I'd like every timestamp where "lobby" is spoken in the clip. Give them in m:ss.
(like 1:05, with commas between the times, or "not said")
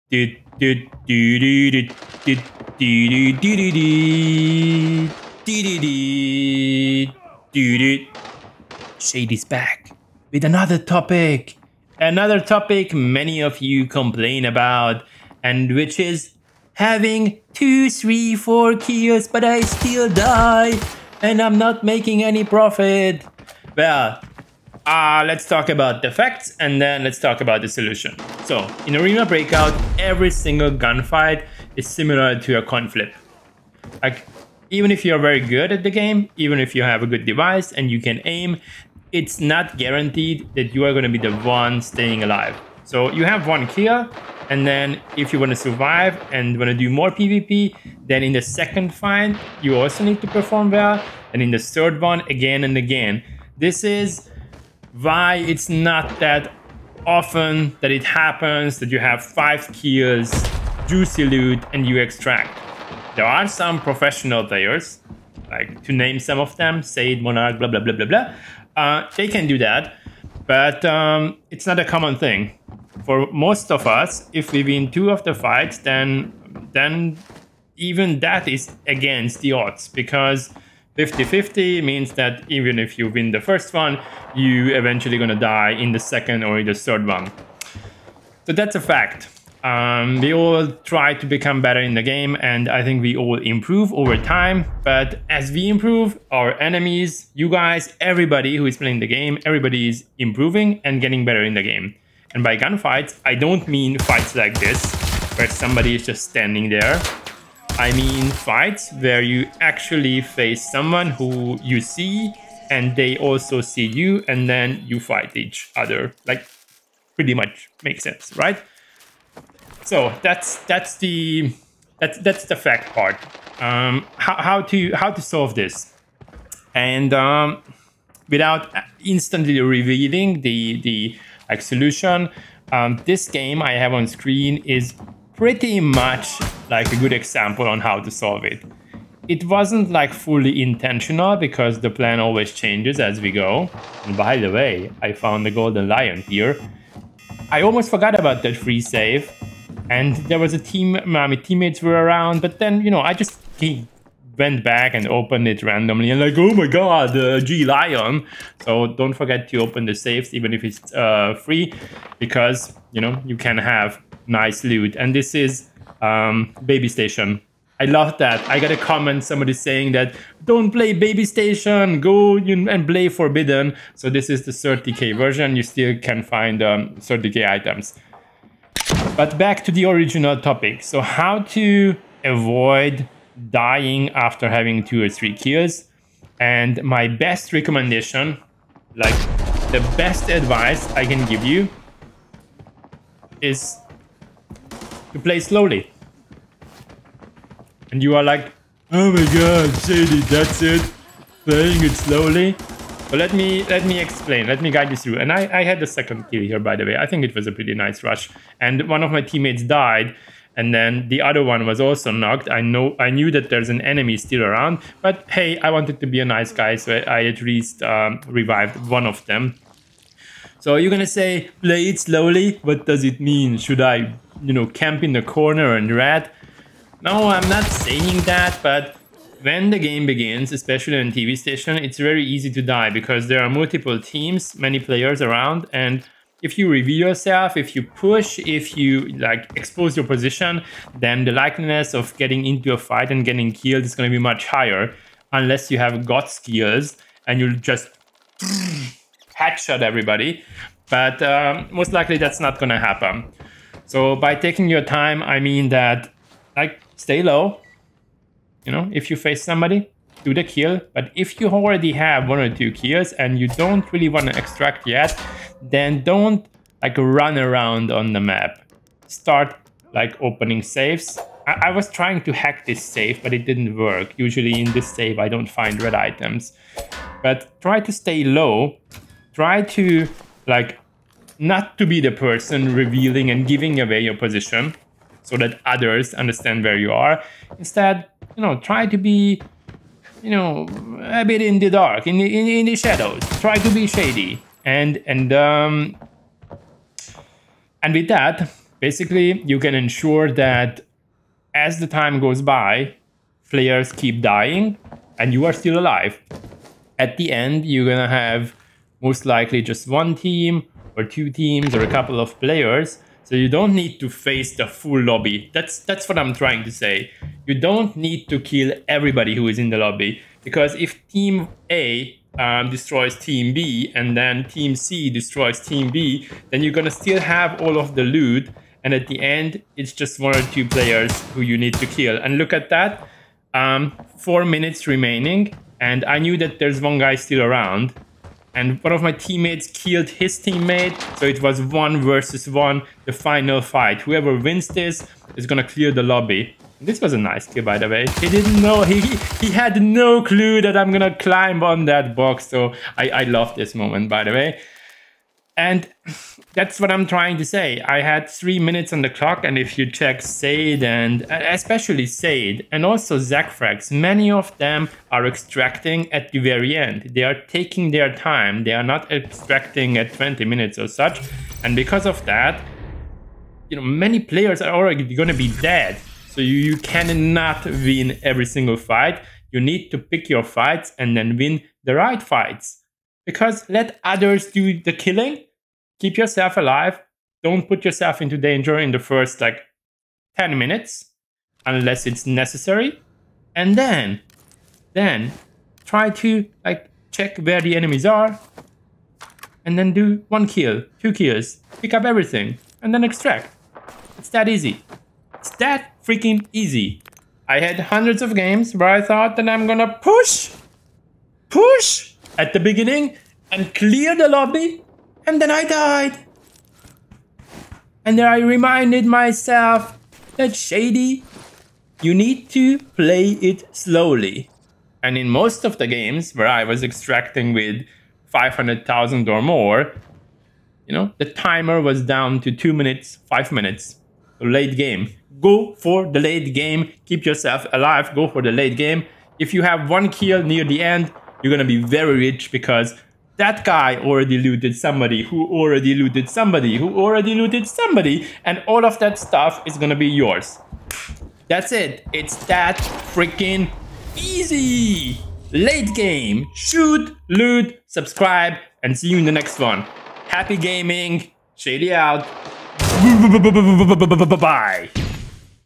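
5:15, 5:19, 5:46, 6:54.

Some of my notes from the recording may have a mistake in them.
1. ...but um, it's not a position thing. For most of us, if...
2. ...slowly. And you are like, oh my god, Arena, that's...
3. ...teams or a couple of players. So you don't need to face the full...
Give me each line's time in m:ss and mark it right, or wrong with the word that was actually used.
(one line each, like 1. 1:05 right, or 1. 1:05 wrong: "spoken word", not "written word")
1. 1:10 wrong: "common", not "position"
2. 3:15 wrong: "Shady", not "Arena"
3. 5:11 right.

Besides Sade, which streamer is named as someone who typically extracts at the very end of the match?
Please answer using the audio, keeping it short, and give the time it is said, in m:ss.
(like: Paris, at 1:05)
Zachfrax, at 6:03.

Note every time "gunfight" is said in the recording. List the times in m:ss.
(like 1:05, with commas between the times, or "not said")
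0:30, 1:42.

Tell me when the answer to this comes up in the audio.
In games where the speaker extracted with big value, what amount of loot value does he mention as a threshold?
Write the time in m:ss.
7:08.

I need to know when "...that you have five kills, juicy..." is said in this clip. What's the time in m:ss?
0:58.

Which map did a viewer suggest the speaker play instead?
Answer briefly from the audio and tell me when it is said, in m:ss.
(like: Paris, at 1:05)
Forbidden, at 2:53.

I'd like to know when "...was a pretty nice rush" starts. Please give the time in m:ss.
3:27.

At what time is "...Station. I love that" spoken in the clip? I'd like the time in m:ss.
2:46.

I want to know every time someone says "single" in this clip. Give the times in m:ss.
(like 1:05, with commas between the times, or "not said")
0:30, 6:18.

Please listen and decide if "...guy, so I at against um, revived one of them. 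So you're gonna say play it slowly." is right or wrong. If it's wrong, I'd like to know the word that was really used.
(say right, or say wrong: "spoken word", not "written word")
wrong: "least", not "against".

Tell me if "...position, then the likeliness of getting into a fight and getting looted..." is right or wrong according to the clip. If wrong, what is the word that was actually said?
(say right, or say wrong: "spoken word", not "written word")
wrong: "killed", not "looted".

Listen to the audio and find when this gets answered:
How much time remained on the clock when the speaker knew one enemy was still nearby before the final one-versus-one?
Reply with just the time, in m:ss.
5:34.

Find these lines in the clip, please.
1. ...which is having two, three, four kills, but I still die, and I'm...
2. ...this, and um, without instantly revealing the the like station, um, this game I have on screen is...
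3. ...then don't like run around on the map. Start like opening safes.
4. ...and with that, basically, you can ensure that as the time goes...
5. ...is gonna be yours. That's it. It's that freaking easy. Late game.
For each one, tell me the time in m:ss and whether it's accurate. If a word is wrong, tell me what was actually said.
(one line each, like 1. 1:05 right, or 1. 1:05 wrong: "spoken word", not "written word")
1. 0:15 right
2. 2:05 wrong: "solution", not "station"
3. 4:25 right
4. 4:57 right
5. 7:29 right.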